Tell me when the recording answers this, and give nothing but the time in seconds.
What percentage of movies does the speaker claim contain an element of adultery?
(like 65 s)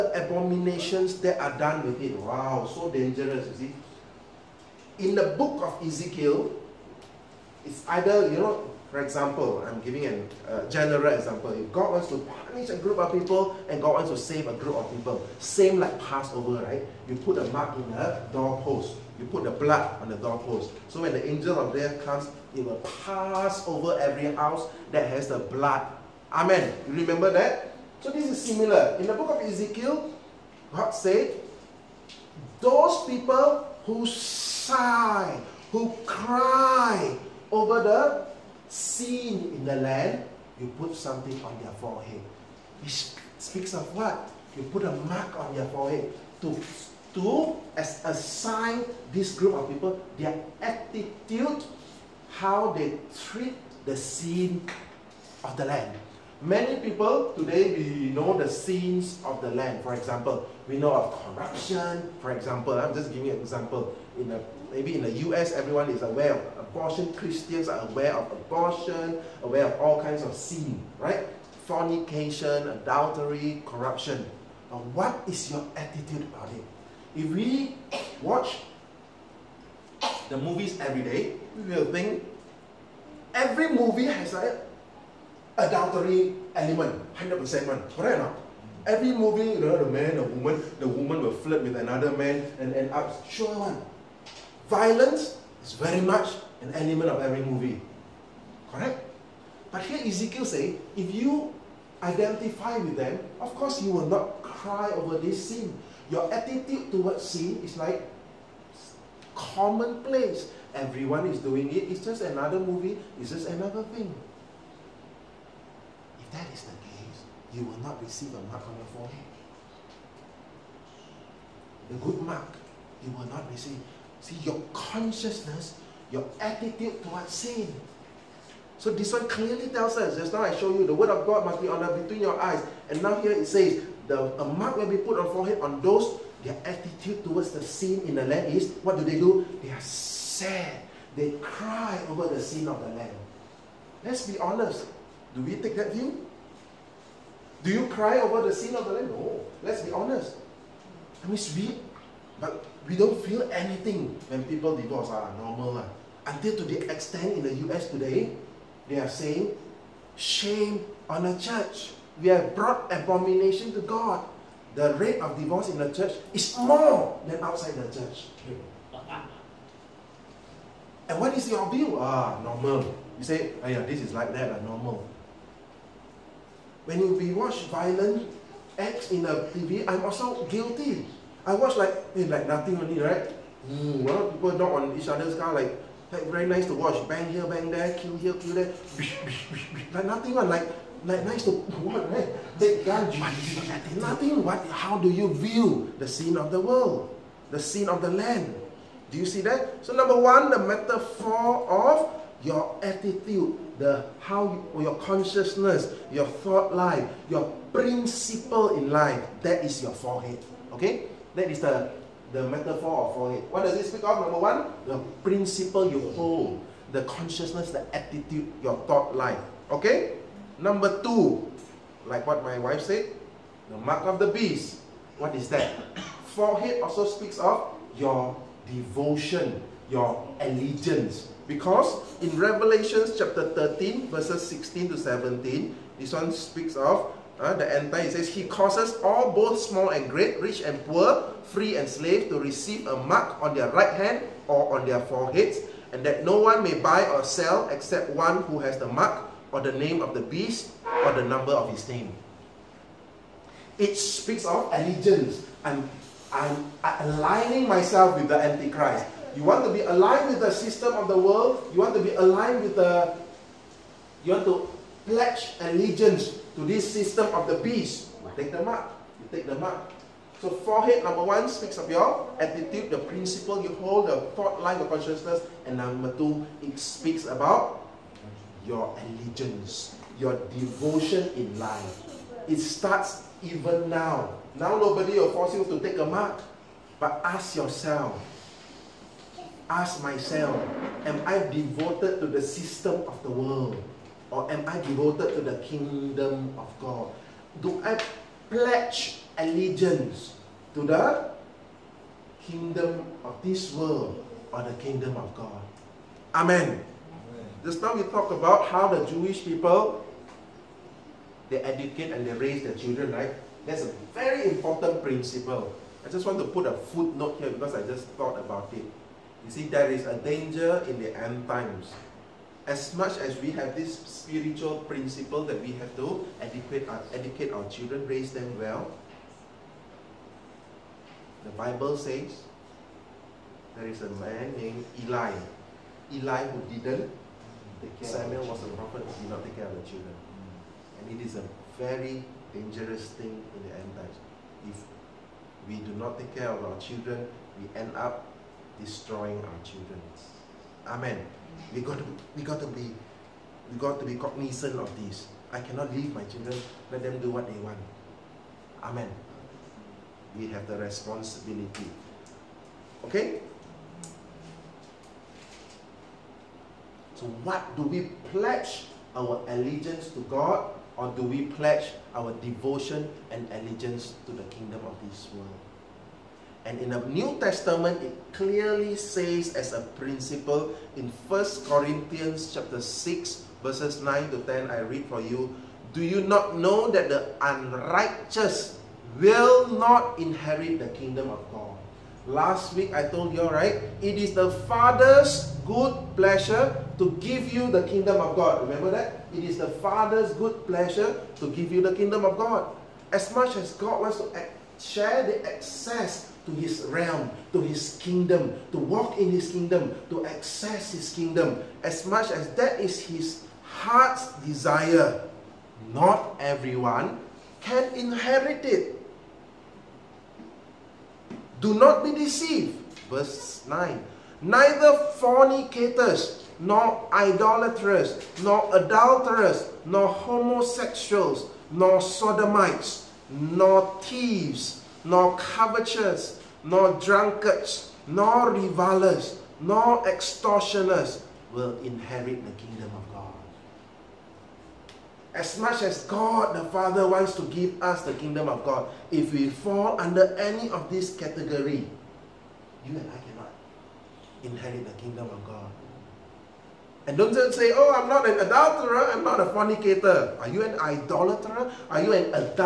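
87 s.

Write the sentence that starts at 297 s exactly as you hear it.
Do I pledge allegiance to the kingdom of this world or the kingdom of God?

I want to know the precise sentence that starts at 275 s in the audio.
And number two, it speaks about your allegiance, your devotion in life.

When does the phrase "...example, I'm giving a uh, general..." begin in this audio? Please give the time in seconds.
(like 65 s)
8 s.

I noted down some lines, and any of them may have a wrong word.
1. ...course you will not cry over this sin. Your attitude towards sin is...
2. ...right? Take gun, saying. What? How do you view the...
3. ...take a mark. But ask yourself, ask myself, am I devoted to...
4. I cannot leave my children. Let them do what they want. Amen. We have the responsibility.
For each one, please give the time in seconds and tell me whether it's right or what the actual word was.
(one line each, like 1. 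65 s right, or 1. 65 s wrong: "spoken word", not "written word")
1. 103 s right
2. 192 s wrong: "nothing", not "saying"
3. 285 s right
4. 355 s right.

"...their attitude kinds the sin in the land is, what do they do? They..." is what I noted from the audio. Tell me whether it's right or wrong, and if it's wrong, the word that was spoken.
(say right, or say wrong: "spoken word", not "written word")
wrong: "towards", not "kinds".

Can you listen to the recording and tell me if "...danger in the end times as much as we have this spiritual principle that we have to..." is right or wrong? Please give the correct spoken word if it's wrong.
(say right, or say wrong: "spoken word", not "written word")
right.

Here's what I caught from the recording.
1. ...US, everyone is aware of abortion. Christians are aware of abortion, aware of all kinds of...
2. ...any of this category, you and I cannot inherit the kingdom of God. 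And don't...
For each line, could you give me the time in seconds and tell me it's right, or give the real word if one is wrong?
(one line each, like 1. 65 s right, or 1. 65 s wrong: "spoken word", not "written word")
1. 65 s right
2. 450 s right.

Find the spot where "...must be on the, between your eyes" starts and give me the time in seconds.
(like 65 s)
131 s.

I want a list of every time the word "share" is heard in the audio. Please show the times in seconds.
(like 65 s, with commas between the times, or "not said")
404 s.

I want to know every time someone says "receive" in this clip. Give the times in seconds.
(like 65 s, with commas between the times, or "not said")
118 s, 123 s, 242 s.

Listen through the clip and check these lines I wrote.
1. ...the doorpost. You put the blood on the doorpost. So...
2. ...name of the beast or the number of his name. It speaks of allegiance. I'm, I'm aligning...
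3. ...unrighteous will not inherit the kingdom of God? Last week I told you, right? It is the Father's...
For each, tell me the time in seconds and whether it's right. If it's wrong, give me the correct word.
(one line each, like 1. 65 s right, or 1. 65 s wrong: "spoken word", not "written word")
1. 17 s right
2. 249 s right
3. 387 s right.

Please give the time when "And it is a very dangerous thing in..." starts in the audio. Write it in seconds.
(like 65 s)
341 s.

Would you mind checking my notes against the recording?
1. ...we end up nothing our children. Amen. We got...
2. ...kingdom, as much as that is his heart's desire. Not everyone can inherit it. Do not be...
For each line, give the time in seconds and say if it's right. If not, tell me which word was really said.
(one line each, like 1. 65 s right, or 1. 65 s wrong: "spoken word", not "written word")
1. 347 s wrong: "destroying", not "nothing"
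2. 411 s right.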